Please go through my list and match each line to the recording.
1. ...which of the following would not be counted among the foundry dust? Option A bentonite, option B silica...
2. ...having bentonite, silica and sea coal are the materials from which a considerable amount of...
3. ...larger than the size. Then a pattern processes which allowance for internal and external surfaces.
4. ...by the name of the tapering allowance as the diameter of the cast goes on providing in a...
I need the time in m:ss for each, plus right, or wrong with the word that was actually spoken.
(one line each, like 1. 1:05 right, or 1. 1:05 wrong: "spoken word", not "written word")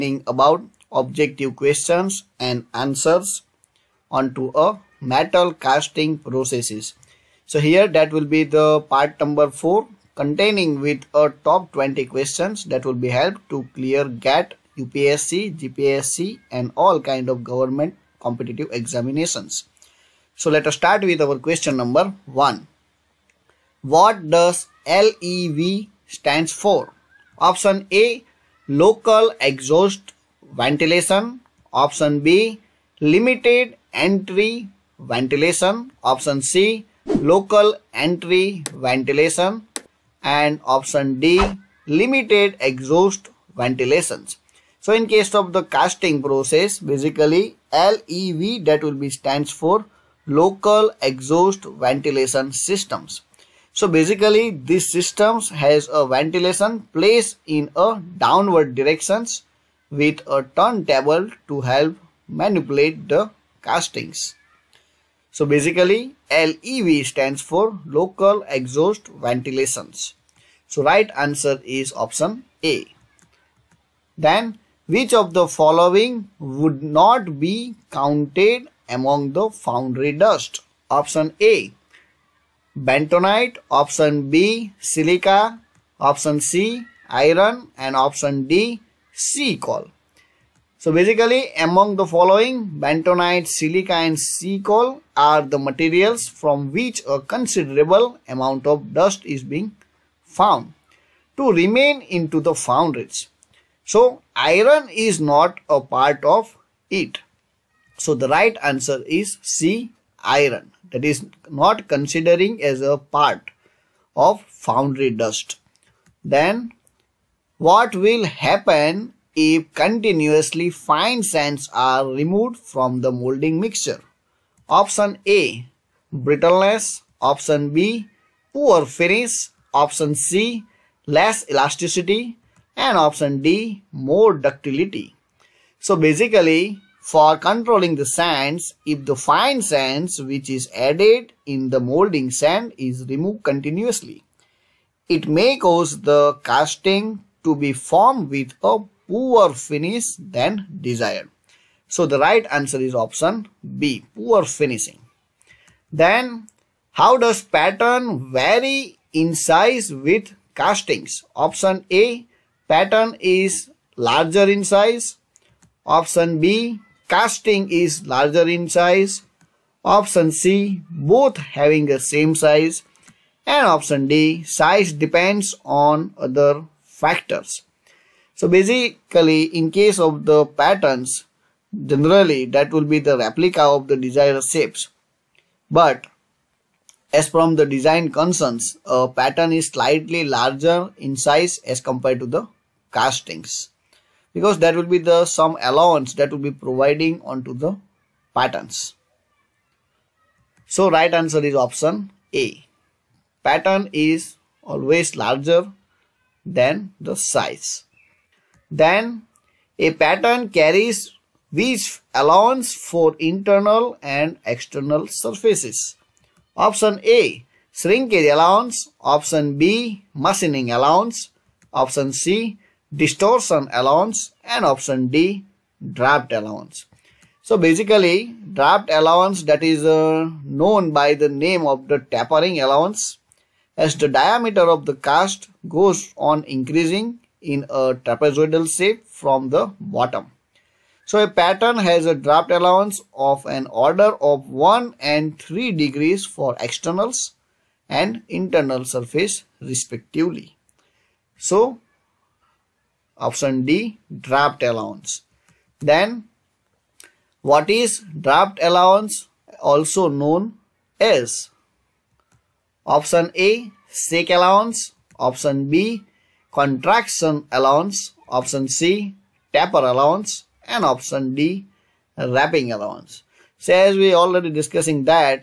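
1. 1:14 right
2. 1:32 wrong: "following", not "having"
3. 3:25 wrong: "carries", not "processes"
4. 3:50 wrong: "increasing", not "providing".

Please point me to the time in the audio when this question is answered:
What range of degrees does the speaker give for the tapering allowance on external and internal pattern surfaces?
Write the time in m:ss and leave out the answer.
4:04.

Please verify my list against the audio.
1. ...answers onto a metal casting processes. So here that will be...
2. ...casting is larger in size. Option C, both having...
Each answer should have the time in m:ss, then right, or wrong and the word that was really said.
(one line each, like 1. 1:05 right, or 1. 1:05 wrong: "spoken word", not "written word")
1. 0:02 right
2. 2:47 right.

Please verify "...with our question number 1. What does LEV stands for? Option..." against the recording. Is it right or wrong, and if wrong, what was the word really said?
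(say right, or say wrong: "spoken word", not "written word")
right.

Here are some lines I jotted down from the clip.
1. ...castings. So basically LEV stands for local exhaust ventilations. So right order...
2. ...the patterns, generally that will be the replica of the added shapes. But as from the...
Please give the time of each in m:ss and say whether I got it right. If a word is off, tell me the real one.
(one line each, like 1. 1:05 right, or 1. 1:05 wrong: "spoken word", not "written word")
1. 1:03 wrong: "answer", not "order"
2. 3:00 wrong: "desired", not "added".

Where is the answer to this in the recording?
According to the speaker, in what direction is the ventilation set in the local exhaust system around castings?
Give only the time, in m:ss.
0:58.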